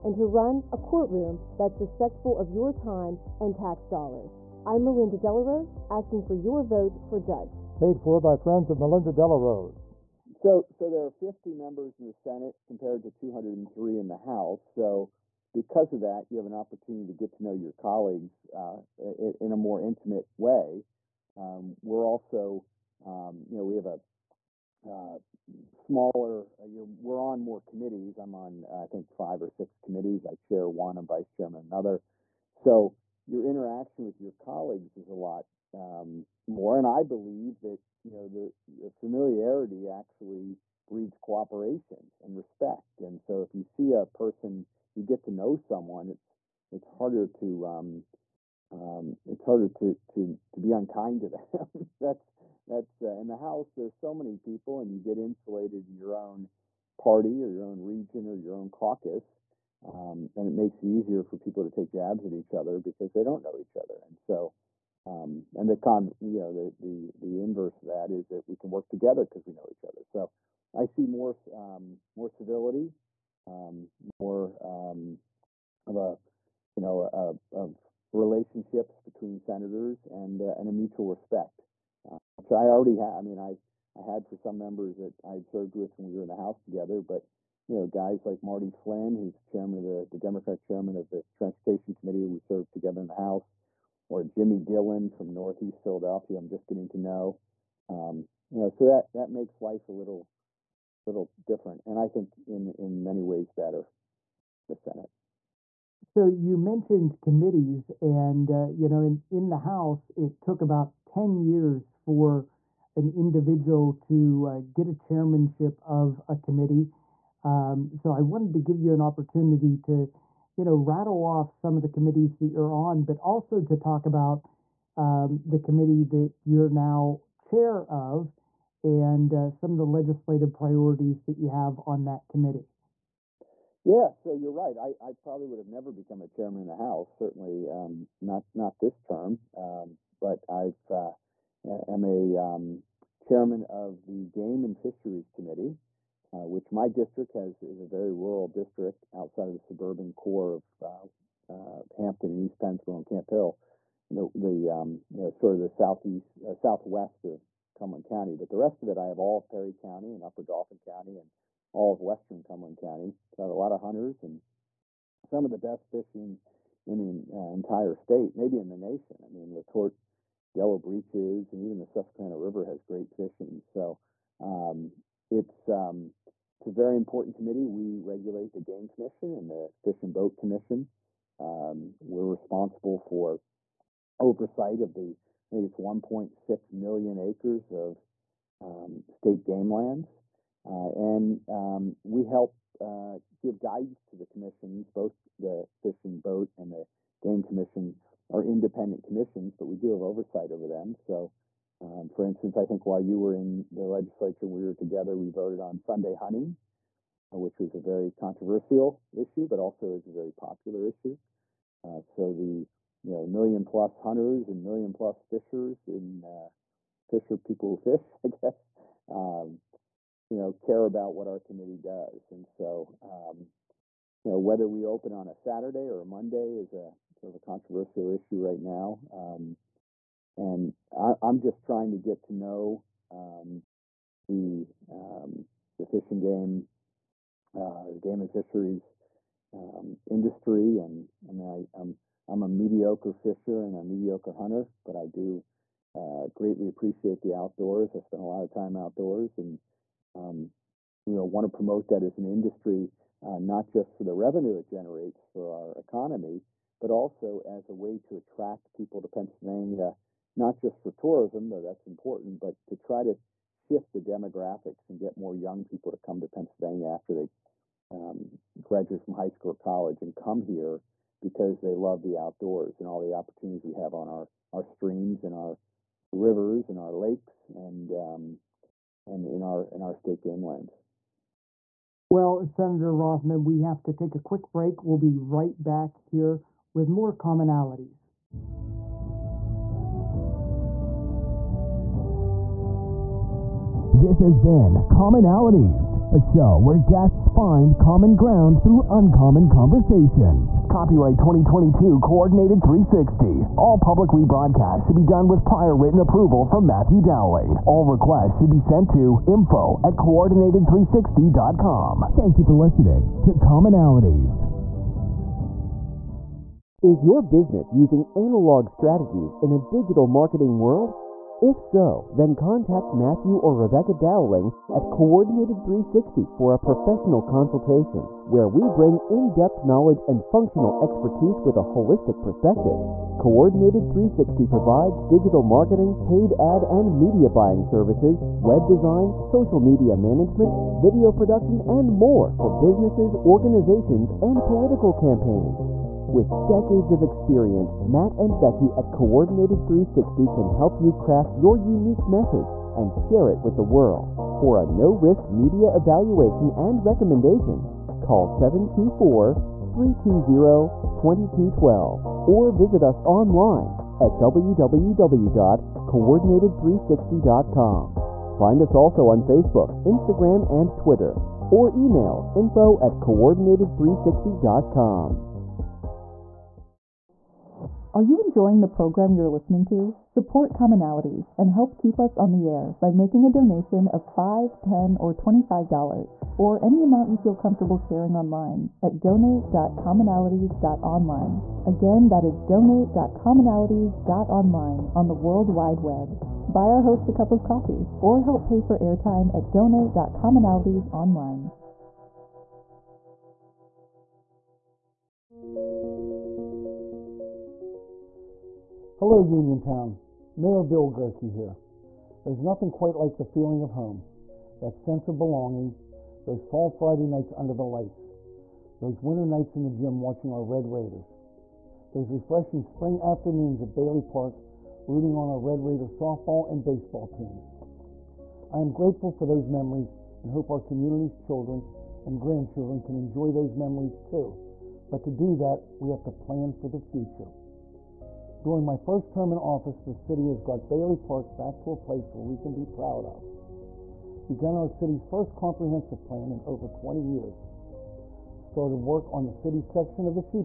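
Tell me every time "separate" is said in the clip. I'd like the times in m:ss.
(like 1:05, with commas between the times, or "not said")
not said.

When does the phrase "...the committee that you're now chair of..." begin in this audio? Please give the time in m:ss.
2:05.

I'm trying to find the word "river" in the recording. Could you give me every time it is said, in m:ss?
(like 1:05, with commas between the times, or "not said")
2:52, 4:36.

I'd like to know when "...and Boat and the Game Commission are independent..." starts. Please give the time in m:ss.
3:16.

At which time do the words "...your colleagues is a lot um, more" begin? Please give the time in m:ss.
0:34.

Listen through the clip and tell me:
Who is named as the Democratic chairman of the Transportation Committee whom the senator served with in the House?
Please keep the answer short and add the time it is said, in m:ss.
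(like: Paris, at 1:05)
Marty Flynn, at 1:28.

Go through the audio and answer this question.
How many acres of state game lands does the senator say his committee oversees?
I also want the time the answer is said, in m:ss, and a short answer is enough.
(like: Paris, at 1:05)
1.6 million, at 3:05.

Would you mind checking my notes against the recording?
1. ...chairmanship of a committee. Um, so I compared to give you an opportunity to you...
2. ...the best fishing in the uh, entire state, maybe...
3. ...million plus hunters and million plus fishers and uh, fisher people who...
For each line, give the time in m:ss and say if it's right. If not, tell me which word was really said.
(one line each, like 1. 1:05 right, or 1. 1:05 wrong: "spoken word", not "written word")
1. 1:54 wrong: "wanted", not "compared"
2. 2:45 right
3. 3:33 right.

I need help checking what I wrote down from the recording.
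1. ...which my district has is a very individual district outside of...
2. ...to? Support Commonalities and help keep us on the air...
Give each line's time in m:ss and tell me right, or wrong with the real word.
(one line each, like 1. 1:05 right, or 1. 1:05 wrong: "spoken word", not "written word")
1. 2:26 wrong: "rural", not "individual"
2. 6:19 right.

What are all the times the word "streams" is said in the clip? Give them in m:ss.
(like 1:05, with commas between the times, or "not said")
4:34.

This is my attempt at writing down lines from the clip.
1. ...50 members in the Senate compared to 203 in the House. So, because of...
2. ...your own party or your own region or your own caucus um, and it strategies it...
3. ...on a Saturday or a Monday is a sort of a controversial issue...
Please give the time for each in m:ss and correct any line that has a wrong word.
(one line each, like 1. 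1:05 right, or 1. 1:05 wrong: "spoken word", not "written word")
1. 0:11 right
2. 0:55 wrong: "makes", not "strategies"
3. 3:45 right.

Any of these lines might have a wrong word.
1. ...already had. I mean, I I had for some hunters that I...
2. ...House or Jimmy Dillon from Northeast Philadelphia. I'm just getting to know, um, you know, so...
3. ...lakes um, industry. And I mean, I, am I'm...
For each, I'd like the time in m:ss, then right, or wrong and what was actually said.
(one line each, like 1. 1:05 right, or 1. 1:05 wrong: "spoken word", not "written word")
1. 1:22 wrong: "members", not "hunters"
2. 1:33 right
3. 3:58 wrong: "fisheries", not "lakes".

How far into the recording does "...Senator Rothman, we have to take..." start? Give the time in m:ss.
4:42.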